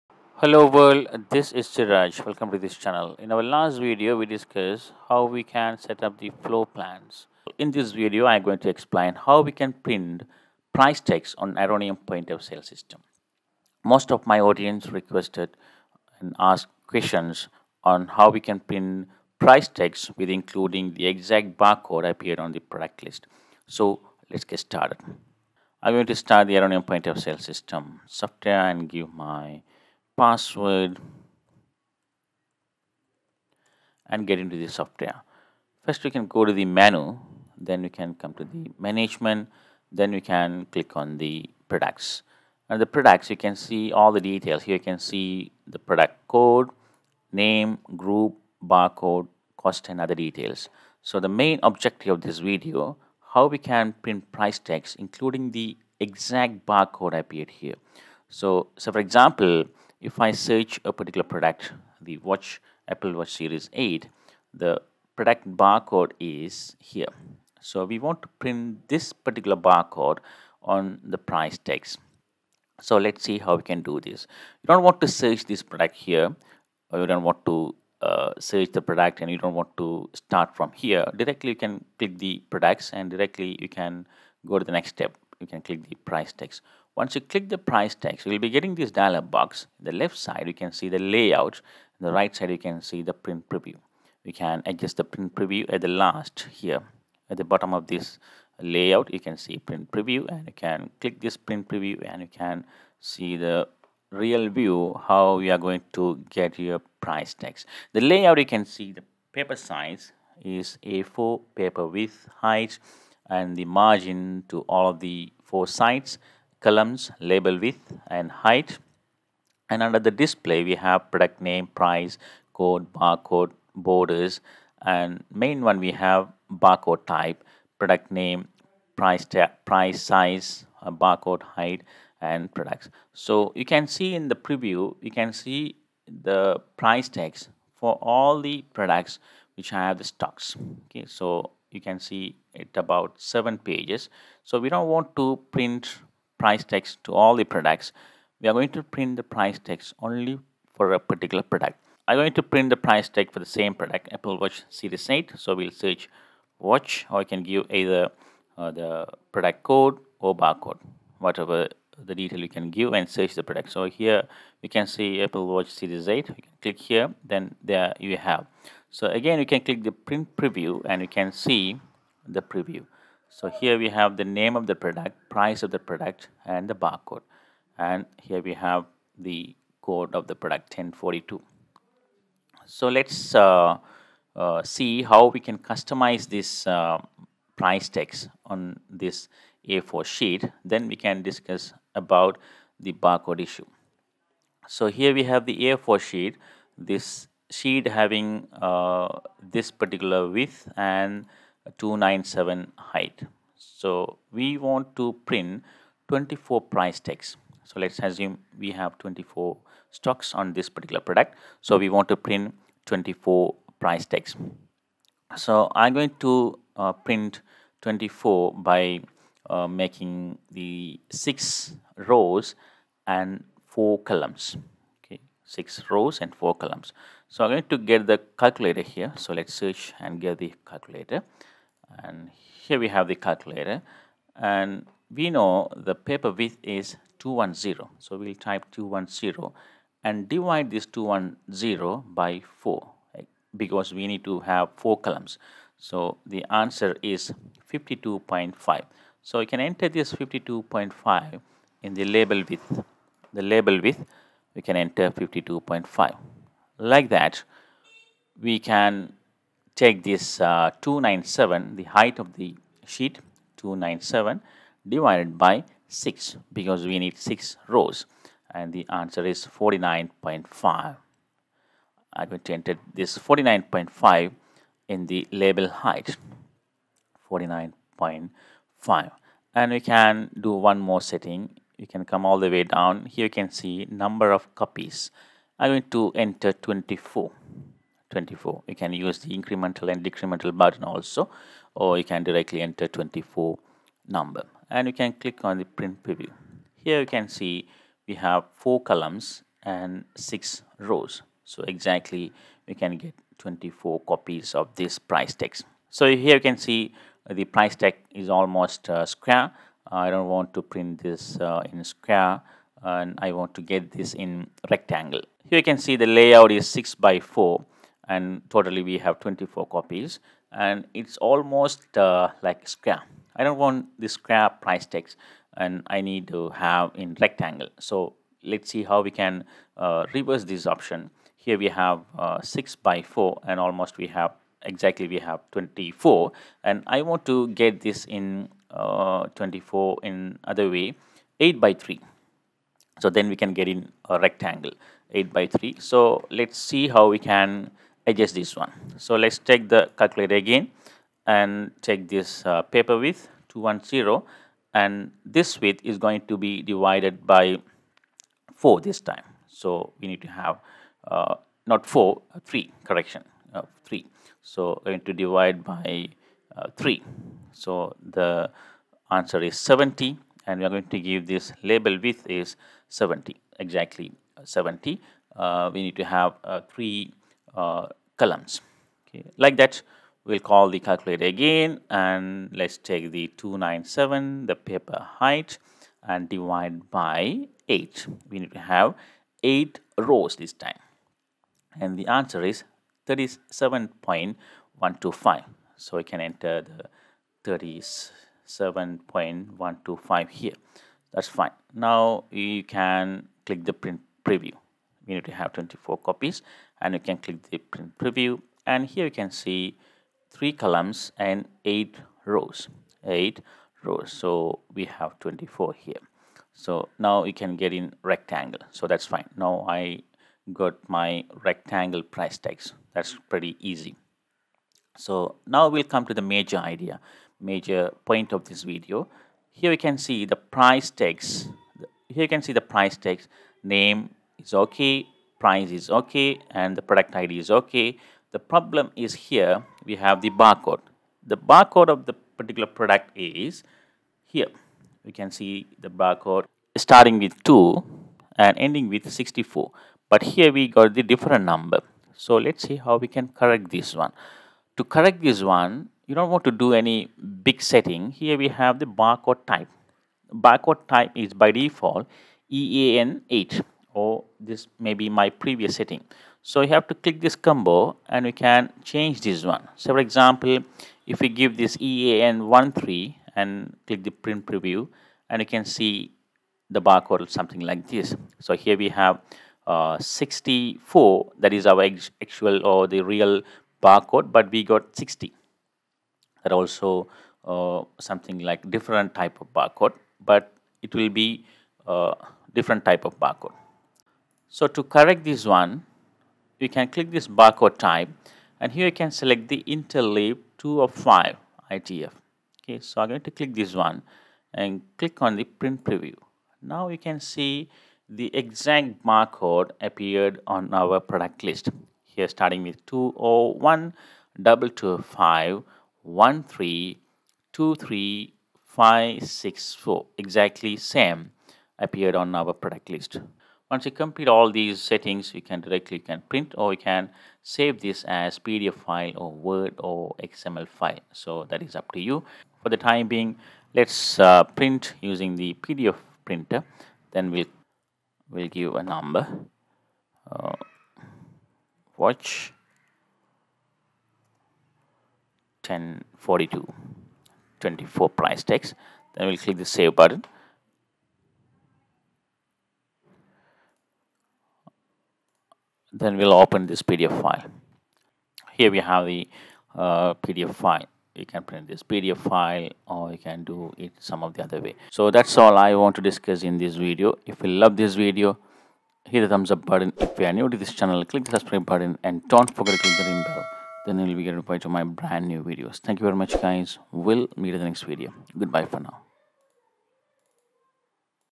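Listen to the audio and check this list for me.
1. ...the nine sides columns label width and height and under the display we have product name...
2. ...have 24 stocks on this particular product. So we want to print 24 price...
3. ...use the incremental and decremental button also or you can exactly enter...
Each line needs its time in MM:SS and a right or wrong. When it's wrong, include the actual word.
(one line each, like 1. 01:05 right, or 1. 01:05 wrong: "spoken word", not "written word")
1. 01:54 wrong: "four", not "nine"
2. 03:28 right
3. 04:48 wrong: "directly", not "exactly".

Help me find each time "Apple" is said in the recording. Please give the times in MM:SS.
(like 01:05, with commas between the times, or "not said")
01:02, 02:34, 02:45.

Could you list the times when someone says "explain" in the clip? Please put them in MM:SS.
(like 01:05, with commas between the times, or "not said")
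00:08.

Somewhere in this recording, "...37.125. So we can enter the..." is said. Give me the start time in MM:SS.
06:33.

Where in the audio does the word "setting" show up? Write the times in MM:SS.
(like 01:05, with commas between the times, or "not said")
04:41, 07:37, 07:45, 08:44.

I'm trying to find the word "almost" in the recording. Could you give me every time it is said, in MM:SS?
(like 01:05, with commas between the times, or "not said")
05:08, 05:21, 05:33.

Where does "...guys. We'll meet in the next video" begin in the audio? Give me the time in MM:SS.
09:36.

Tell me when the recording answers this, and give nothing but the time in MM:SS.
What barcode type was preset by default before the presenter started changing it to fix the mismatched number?
07:42.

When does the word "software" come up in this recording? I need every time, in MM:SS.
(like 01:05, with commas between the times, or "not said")
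00:28, 00:34.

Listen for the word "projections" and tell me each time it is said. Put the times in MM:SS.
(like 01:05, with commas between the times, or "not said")
not said.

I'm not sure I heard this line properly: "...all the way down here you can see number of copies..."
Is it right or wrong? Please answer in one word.
right.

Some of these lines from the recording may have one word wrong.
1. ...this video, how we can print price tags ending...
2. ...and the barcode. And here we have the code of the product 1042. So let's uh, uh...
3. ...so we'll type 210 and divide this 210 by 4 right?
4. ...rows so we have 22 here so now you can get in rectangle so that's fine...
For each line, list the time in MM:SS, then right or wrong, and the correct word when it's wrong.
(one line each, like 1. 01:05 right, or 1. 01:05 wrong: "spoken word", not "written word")
1. 00:52 wrong: "including", not "ending"
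2. 02:56 right
3. 03:57 right
4. 06:53 wrong: "24", not "22".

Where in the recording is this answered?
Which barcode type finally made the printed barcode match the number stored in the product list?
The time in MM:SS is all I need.
08:19.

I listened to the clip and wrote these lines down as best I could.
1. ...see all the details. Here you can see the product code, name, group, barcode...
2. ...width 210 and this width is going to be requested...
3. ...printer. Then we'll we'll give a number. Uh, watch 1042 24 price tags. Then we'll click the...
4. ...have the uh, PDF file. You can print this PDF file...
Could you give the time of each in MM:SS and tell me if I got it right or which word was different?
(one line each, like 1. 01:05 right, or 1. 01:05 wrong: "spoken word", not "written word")
1. 00:43 right
2. 05:52 wrong: "divided", not "requested"
3. 08:56 right
4. 09:18 right.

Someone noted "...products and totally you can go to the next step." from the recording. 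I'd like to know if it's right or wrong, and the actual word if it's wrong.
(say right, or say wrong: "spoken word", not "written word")
wrong: "directly", not "totally".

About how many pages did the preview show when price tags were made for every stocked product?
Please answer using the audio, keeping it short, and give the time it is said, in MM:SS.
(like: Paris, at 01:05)
7, at 02:23.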